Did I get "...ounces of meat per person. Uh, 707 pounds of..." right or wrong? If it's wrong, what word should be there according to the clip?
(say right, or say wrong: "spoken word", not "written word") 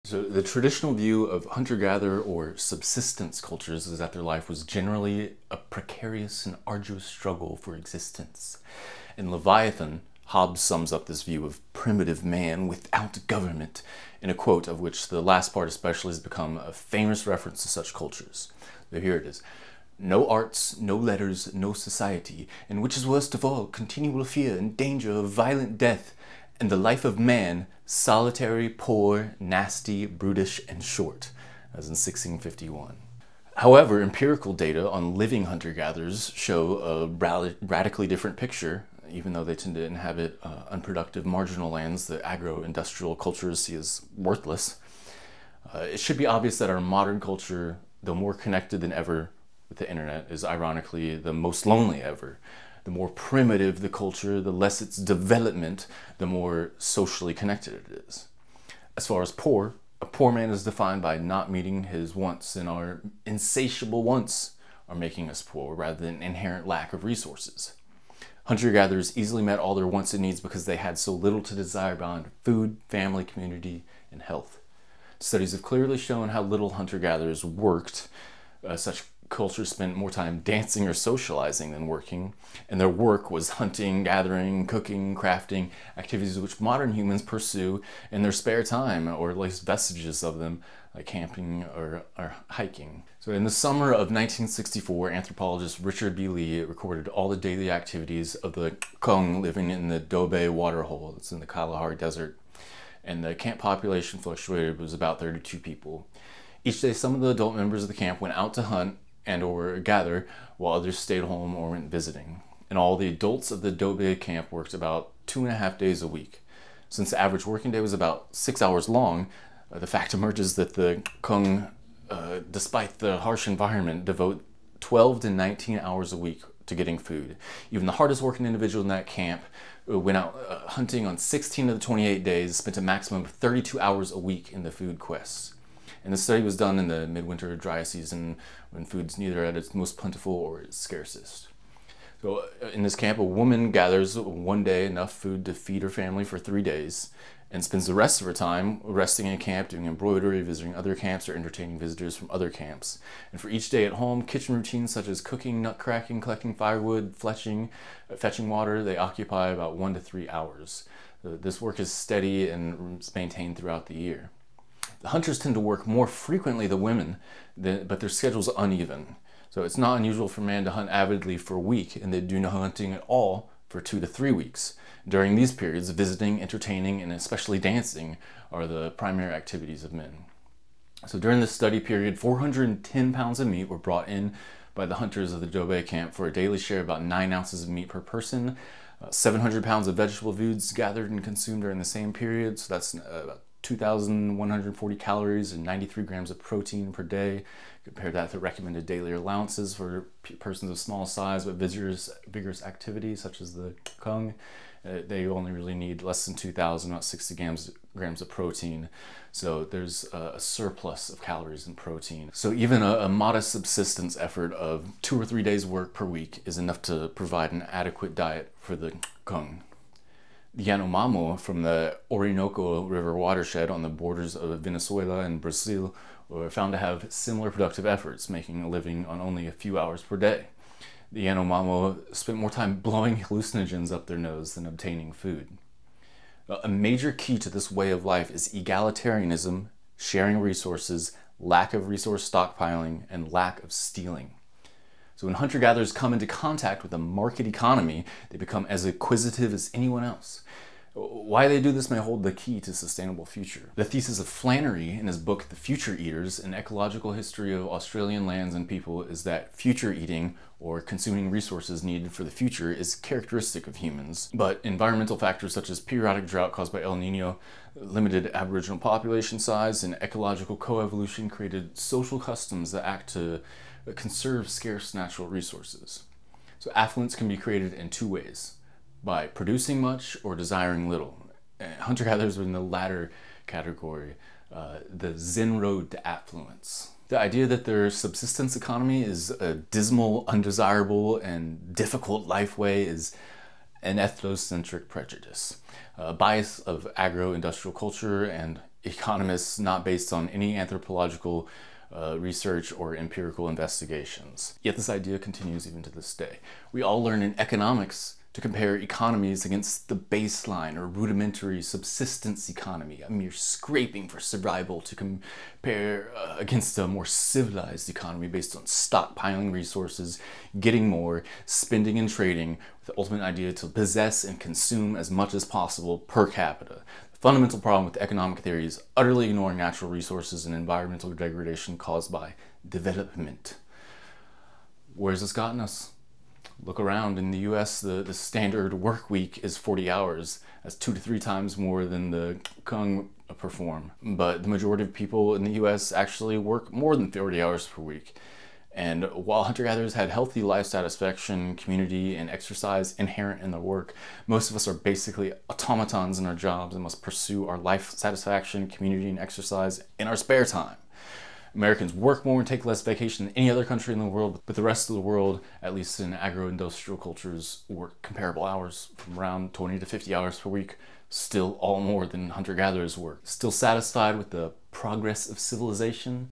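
wrong: "700", not "707".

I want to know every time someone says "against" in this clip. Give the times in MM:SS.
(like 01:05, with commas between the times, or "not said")
05:09, 05:16.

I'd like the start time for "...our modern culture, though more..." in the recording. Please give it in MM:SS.
00:46.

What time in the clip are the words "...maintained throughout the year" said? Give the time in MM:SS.
02:43.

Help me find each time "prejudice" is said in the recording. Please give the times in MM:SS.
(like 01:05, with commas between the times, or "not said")
04:54.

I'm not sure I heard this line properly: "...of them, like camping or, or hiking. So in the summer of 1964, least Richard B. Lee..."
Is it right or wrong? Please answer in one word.
wrong.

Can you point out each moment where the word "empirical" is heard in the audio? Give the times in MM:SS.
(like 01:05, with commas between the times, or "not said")
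00:34, 05:02.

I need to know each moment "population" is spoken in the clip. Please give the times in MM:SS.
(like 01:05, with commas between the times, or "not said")
01:43, 04:28.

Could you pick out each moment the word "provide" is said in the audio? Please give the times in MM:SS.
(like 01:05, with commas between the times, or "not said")
03:37.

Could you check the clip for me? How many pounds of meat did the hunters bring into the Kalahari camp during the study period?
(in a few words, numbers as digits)
410 pounds.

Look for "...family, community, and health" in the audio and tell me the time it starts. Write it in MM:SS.
01:12.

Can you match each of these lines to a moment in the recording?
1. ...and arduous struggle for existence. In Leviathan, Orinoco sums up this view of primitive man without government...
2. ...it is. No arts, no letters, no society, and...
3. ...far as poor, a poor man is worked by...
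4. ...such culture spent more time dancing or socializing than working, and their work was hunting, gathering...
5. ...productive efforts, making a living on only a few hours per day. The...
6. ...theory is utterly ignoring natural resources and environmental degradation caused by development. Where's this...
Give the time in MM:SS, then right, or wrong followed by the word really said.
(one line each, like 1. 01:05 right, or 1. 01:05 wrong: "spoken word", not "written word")
1. 00:06 wrong: "Hobbes", not "Orinoco"
2. 00:19 right
3. 00:59 wrong: "defined", not "worked"
4. 01:18 right
5. 03:47 right
6. 05:28 right.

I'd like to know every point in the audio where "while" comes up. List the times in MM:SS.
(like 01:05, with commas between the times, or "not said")
01:50, 05:49.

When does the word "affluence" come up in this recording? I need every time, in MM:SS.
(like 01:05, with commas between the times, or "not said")
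04:36, 04:46.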